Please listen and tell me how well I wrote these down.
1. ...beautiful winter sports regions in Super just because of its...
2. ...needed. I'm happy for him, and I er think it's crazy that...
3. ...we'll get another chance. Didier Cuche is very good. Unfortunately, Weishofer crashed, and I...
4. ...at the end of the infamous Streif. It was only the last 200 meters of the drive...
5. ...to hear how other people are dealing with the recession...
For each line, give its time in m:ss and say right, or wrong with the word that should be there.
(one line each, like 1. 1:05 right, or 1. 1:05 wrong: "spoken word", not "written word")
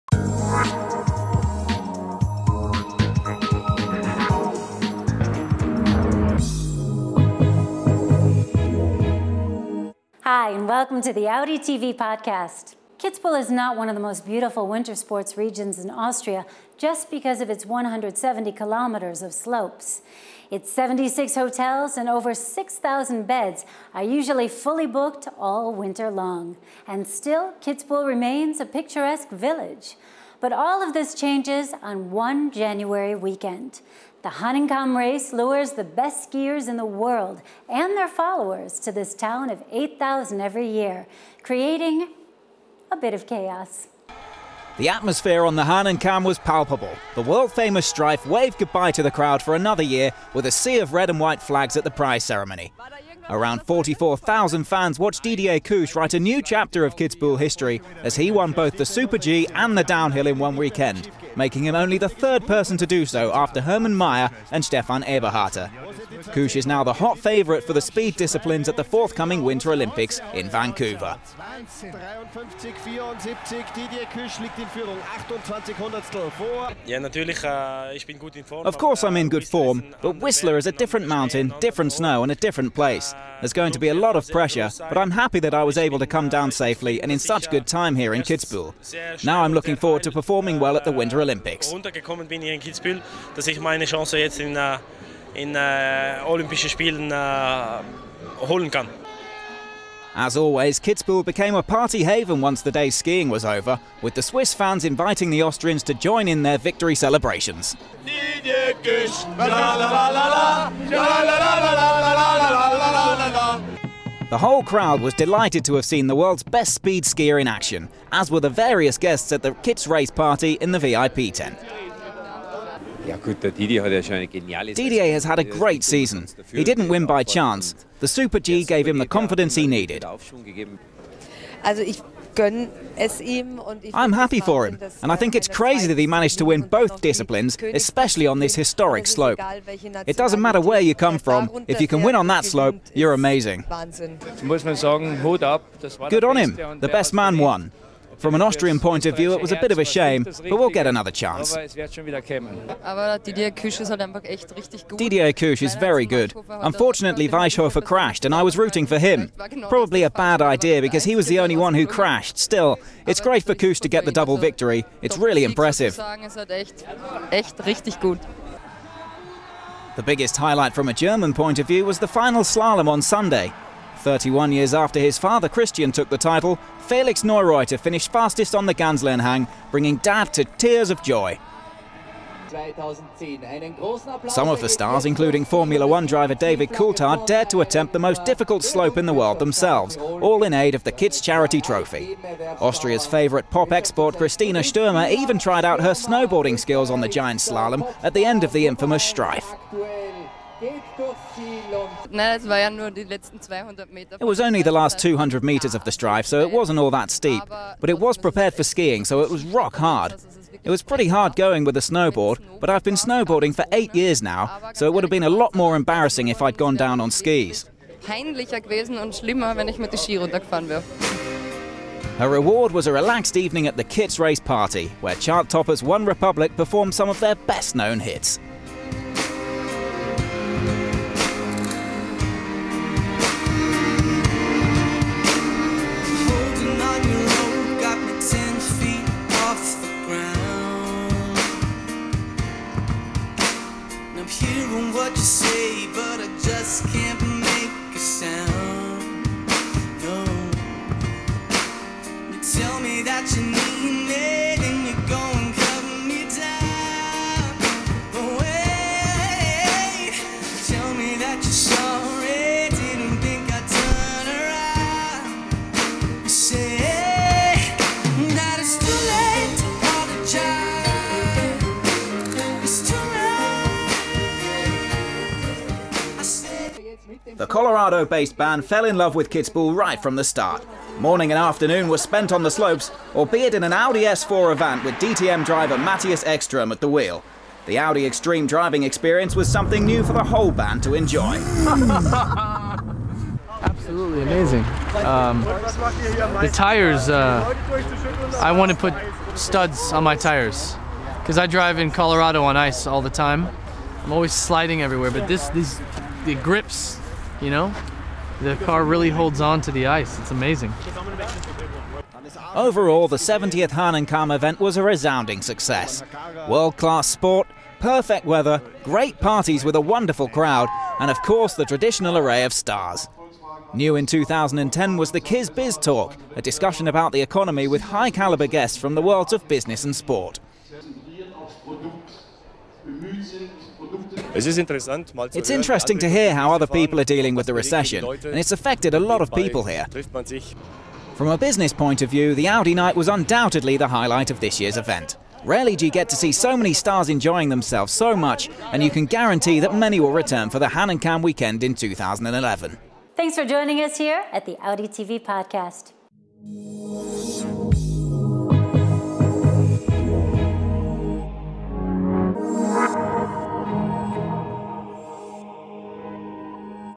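1. 0:14 wrong: "Austria", not "Super"
2. 2:09 right
3. 2:30 right
4. 3:18 right
5. 5:35 right.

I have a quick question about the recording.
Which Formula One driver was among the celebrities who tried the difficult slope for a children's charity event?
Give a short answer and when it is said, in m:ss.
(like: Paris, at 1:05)
David Coulthard, at 3:06.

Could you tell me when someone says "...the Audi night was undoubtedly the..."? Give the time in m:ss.
5:42.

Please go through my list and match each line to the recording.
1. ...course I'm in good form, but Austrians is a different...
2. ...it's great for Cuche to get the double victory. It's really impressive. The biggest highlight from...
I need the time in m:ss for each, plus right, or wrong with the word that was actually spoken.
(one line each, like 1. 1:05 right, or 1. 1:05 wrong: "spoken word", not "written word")
1. 1:18 wrong: "Whistler", not "Austrians"
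2. 2:43 right.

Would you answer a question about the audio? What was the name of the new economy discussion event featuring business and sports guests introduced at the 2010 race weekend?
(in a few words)
Kiz Biz Talk.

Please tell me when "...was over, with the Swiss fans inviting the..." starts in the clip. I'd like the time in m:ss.
1:43.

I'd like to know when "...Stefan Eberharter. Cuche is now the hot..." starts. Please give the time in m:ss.
1:04.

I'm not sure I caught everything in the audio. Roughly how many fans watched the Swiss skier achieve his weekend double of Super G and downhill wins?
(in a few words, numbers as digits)
44,000.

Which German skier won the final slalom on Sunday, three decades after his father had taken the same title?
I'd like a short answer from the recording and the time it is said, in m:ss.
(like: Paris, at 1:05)
Felix Neureuther, at 2:56.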